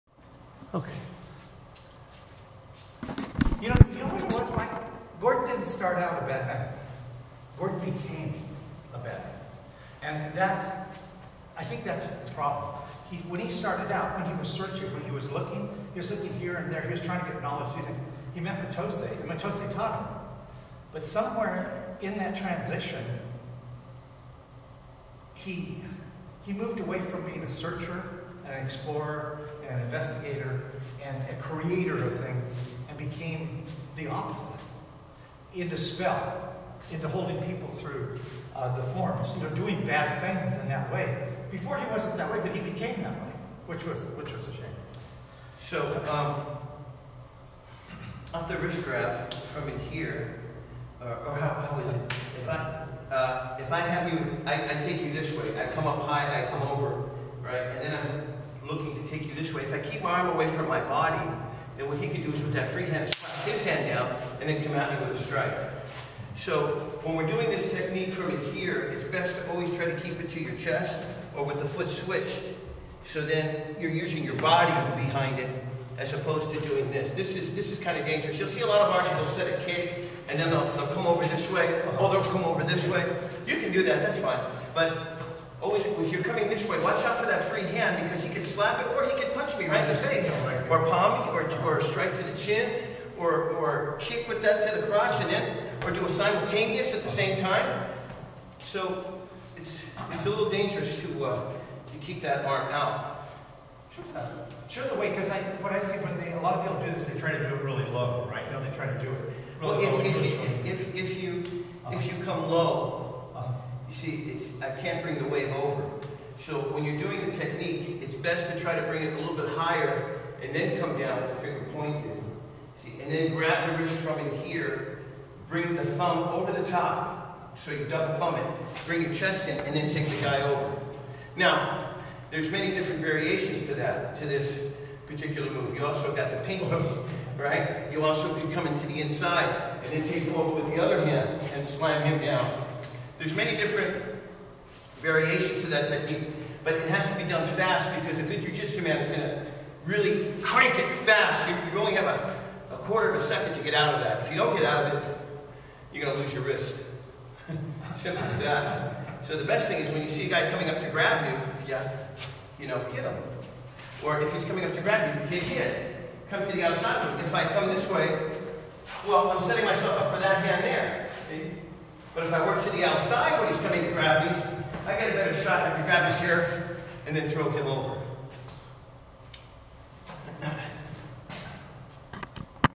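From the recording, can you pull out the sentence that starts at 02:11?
Now, there's many different variations to that, to this particular move.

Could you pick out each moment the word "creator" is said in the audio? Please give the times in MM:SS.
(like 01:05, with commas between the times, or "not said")
00:31.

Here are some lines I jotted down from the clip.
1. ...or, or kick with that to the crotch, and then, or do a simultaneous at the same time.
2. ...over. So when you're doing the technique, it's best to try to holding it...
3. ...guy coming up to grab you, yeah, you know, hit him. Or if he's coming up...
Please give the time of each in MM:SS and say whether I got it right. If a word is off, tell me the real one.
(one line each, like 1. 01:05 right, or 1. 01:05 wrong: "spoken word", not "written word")
1. 01:33 right
2. 01:55 wrong: "bring", not "holding"
3. 02:40 right.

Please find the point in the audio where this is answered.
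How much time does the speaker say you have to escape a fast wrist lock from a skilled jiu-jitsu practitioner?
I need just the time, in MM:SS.
02:32.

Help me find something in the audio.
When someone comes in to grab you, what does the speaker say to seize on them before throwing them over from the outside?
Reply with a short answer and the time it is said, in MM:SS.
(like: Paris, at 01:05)
hair, at 02:56.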